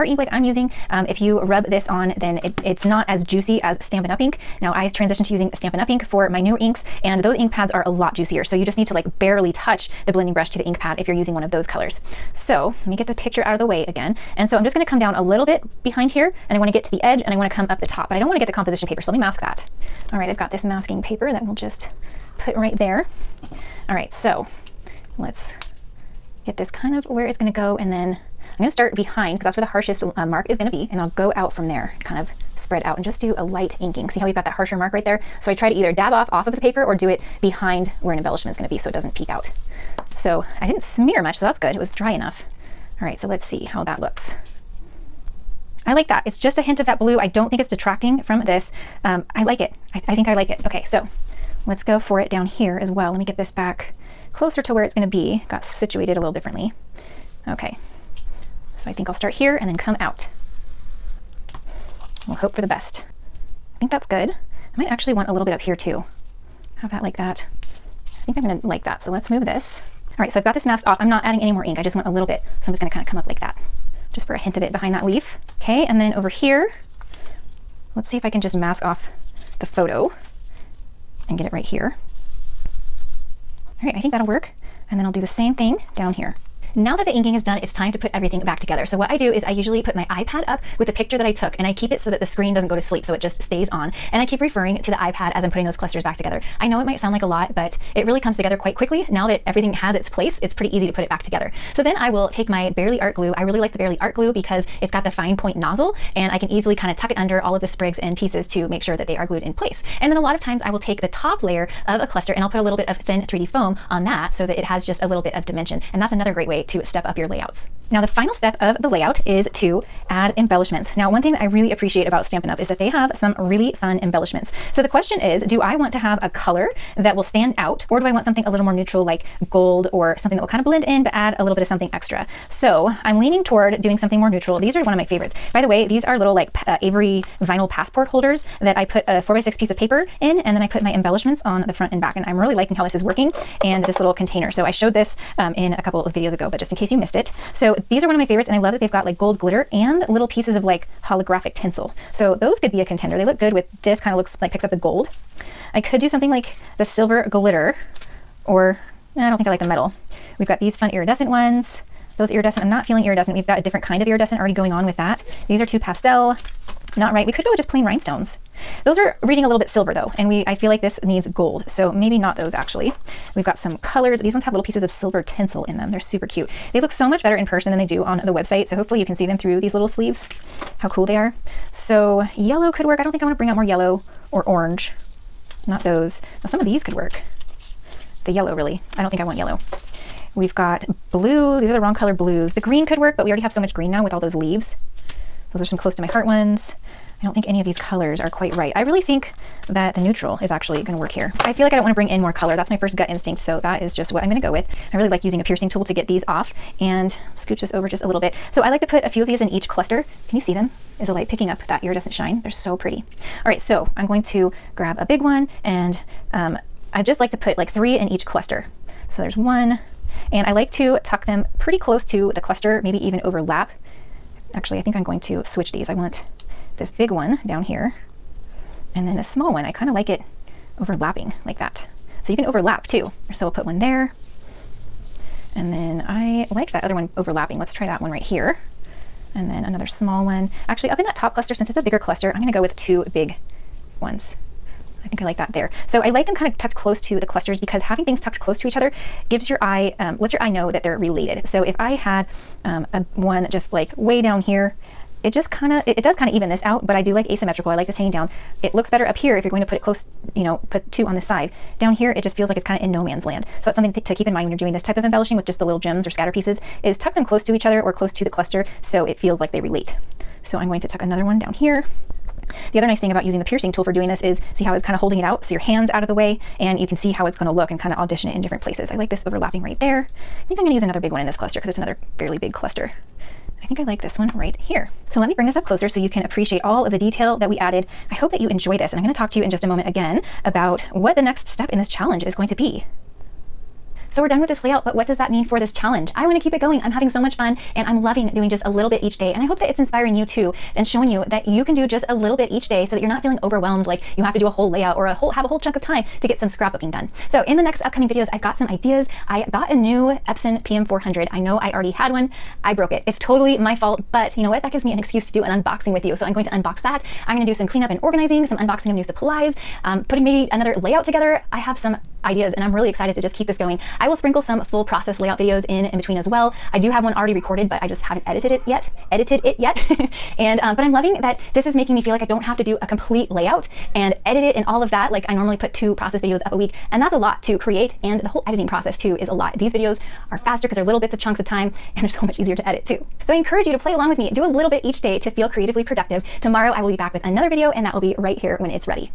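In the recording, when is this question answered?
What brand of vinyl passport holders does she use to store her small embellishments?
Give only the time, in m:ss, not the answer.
2:16.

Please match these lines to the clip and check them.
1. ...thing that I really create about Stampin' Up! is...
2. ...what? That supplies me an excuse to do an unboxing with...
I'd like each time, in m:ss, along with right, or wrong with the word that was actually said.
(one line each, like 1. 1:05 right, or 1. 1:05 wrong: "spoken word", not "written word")
1. 2:01 wrong: "appreciate", not "create"
2. 5:14 wrong: "gives", not "supplies".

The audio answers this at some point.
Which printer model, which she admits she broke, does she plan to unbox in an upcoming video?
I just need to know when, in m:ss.
5:10.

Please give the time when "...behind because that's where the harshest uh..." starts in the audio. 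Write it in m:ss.
0:28.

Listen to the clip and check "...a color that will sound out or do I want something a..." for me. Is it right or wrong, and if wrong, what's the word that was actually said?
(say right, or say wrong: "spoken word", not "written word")
wrong: "stand", not "sound".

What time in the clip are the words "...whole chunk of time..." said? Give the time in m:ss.
5:05.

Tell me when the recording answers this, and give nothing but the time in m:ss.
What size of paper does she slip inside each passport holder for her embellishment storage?
2:19.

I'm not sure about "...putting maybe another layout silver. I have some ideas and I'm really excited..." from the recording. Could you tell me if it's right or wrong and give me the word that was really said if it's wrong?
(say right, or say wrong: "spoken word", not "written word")
wrong: "together", not "silver".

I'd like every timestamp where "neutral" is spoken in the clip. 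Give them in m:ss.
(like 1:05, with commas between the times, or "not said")
2:08, 2:14, 3:19.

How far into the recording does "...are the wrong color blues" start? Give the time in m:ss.
3:11.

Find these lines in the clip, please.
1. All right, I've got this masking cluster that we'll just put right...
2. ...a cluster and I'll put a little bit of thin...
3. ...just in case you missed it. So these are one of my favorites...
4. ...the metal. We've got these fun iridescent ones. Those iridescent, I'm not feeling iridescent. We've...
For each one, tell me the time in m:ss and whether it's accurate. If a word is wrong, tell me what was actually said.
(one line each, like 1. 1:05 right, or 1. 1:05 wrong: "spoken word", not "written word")
1. 0:20 wrong: "paper", not "cluster"
2. 1:51 right
3. 2:26 right
4. 2:39 right.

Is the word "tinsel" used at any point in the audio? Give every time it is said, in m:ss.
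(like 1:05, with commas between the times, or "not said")
2:31, 2:55.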